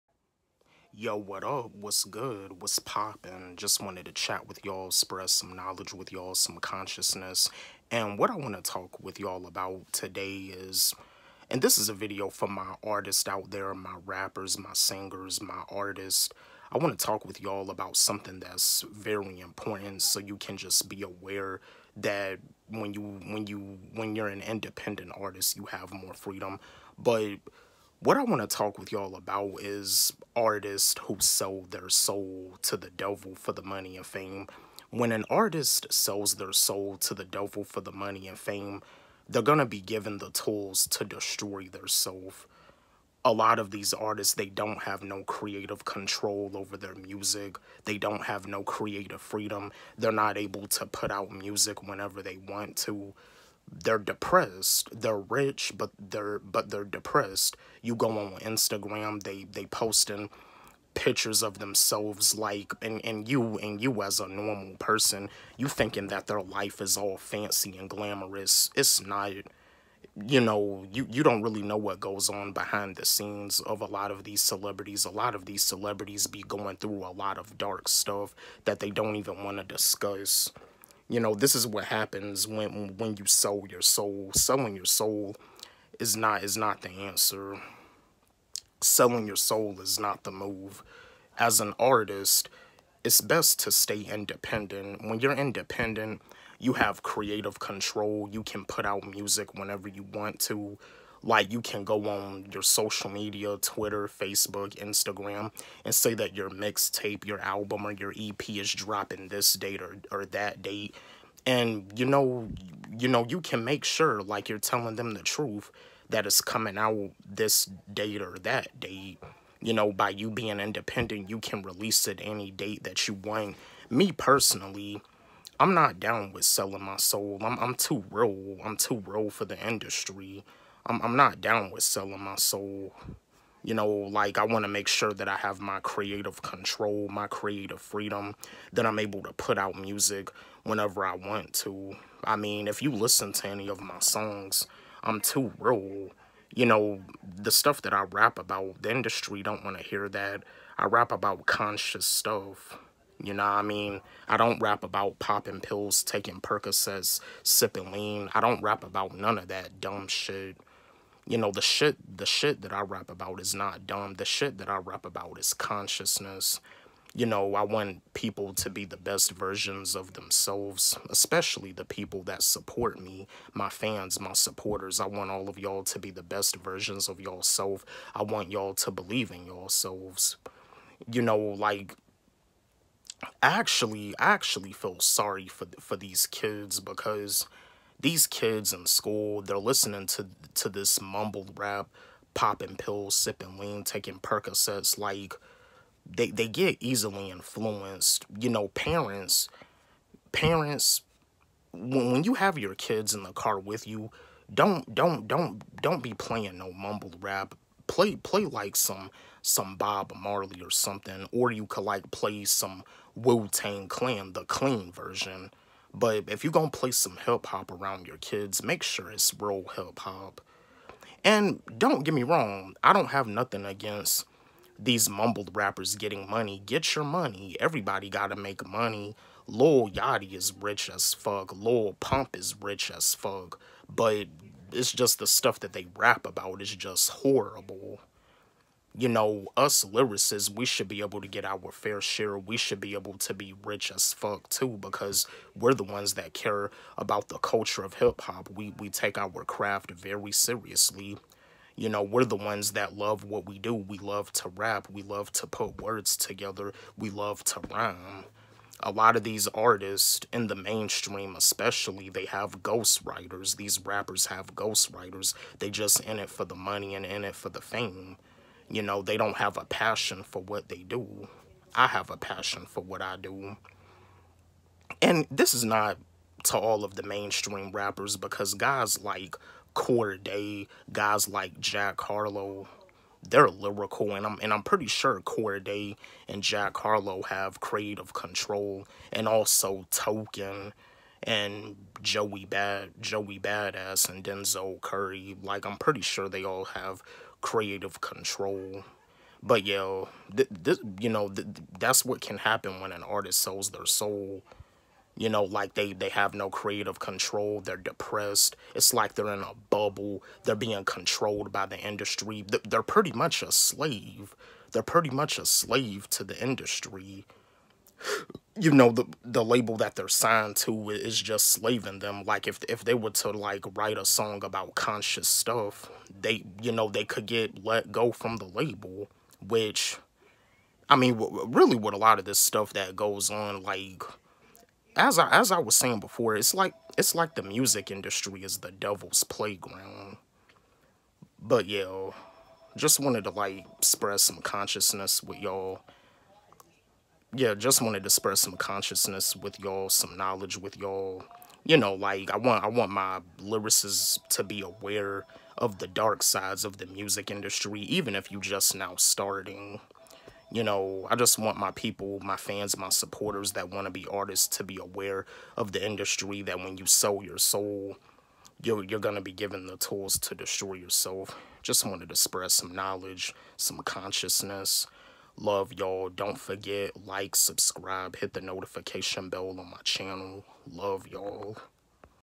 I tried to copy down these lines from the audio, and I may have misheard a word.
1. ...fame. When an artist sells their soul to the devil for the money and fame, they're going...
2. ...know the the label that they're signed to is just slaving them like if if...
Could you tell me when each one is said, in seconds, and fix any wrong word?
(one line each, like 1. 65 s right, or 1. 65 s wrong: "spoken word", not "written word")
1. 34 s right
2. 318 s right.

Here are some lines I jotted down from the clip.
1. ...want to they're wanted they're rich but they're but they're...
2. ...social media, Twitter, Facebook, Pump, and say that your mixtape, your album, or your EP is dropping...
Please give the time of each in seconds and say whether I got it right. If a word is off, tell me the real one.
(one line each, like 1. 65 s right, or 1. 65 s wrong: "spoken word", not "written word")
1. 52 s wrong: "depressed", not "wanted"
2. 102 s wrong: "Instagram", not "Pump".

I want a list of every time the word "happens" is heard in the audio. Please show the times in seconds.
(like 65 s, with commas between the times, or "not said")
81 s, 302 s.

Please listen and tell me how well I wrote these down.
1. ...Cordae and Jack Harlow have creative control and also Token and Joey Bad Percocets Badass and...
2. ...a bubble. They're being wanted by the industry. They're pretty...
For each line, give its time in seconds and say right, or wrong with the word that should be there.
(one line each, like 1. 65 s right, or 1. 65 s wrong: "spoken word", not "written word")
1. 285 s wrong: "Joey", not "Percocets"
2. 309 s wrong: "controlled", not "wanted".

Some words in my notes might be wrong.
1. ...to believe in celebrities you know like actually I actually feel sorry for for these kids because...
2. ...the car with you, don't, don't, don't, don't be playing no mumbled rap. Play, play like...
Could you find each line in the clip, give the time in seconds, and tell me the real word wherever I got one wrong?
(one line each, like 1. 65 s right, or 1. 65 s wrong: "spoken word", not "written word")
1. 178 s wrong: "yourselves", not "celebrities"
2. 203 s right.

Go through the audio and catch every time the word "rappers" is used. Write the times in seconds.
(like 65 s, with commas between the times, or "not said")
14 s, 225 s, 263 s, 277 s.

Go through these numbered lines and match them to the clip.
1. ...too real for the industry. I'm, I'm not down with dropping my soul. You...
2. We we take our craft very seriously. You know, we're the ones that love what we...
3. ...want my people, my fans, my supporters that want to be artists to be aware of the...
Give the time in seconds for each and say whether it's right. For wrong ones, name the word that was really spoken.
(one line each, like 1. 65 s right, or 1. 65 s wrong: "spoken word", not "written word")
1. 128 s wrong: "selling", not "dropping"
2. 248 s right
3. 361 s right.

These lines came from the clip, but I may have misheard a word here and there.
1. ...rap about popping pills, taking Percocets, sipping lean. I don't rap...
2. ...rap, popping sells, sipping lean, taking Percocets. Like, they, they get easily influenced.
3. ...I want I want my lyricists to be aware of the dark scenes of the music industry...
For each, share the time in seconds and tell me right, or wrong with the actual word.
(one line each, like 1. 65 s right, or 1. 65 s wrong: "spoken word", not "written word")
1. 154 s right
2. 191 s wrong: "pills", not "sells"
3. 352 s wrong: "sides", not "scenes".